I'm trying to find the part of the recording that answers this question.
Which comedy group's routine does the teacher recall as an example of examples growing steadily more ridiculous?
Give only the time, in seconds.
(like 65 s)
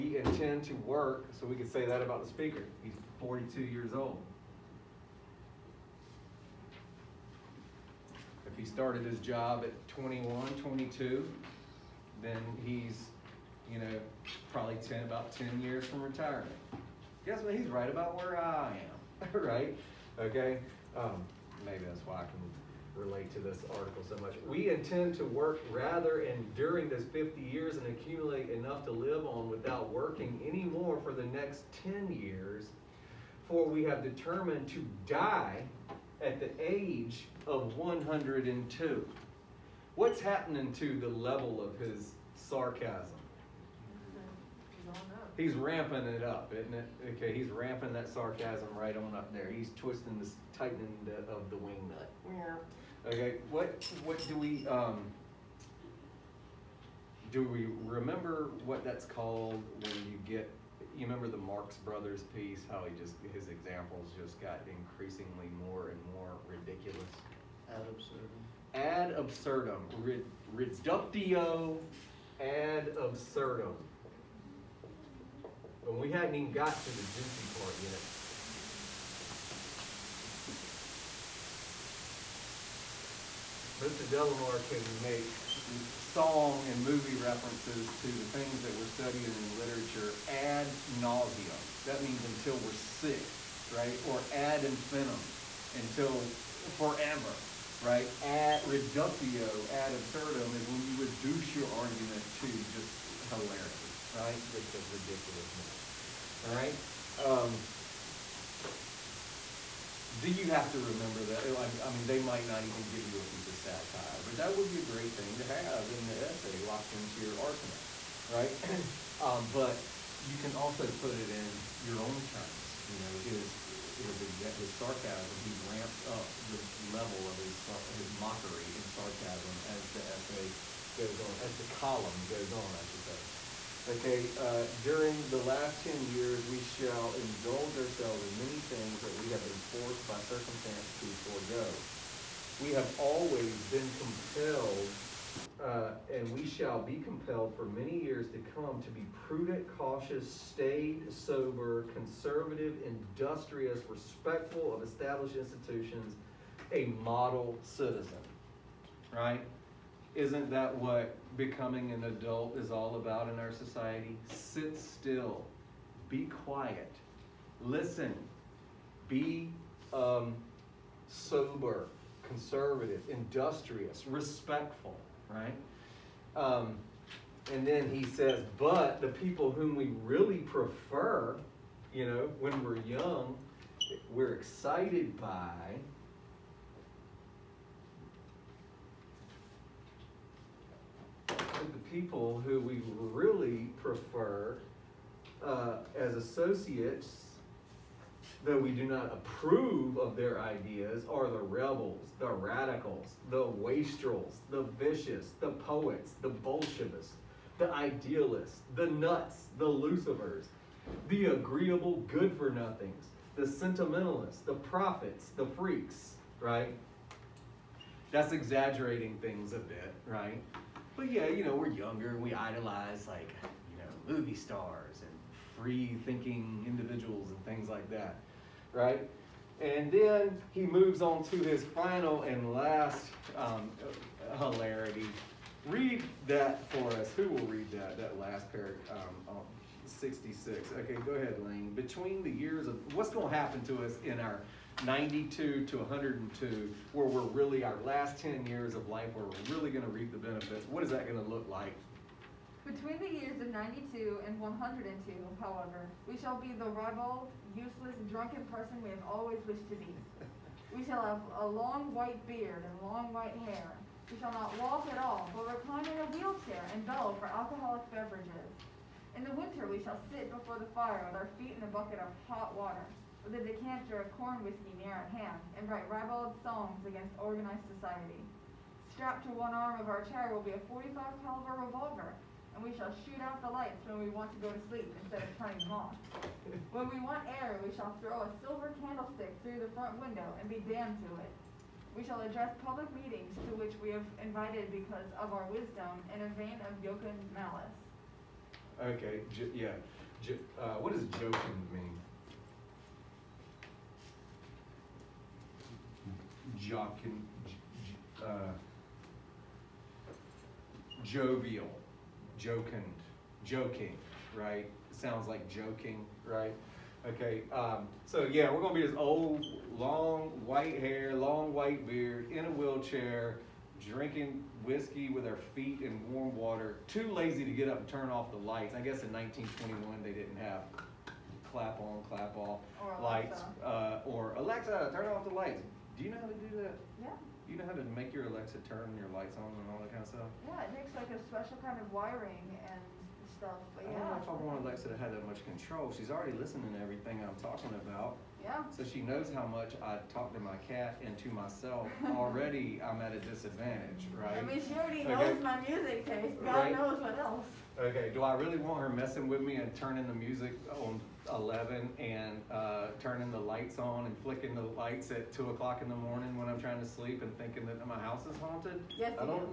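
61 s.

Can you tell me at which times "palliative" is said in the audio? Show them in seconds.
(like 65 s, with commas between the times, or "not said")
not said.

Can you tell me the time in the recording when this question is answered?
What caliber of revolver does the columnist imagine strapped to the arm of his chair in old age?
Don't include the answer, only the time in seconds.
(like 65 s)
280 s.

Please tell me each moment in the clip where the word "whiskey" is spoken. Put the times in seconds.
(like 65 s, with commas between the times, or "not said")
274 s, 324 s.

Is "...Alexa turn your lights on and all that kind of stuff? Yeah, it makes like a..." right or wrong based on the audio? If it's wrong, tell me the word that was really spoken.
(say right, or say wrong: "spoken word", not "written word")
right.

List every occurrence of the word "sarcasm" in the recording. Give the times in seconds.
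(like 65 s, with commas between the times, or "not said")
42 s, 48 s, 124 s, 128 s.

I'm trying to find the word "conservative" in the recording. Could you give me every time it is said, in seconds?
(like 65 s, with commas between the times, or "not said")
151 s, 172 s.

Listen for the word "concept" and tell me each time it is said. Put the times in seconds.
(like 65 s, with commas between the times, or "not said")
not said.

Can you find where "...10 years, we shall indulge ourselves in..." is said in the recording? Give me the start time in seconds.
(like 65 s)
135 s.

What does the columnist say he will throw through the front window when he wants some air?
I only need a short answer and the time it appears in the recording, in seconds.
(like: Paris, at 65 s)
a silver candlestick, at 288 s.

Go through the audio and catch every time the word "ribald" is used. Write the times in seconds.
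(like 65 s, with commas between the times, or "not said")
256 s, 275 s.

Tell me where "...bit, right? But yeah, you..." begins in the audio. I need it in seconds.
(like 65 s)
219 s.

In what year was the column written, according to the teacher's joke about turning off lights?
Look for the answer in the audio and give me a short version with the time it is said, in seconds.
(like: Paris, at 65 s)
1921, at 329 s.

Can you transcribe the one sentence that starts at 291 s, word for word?
We shall address public meetings to which we have invited because of our wisdom in a vein of jocund malice.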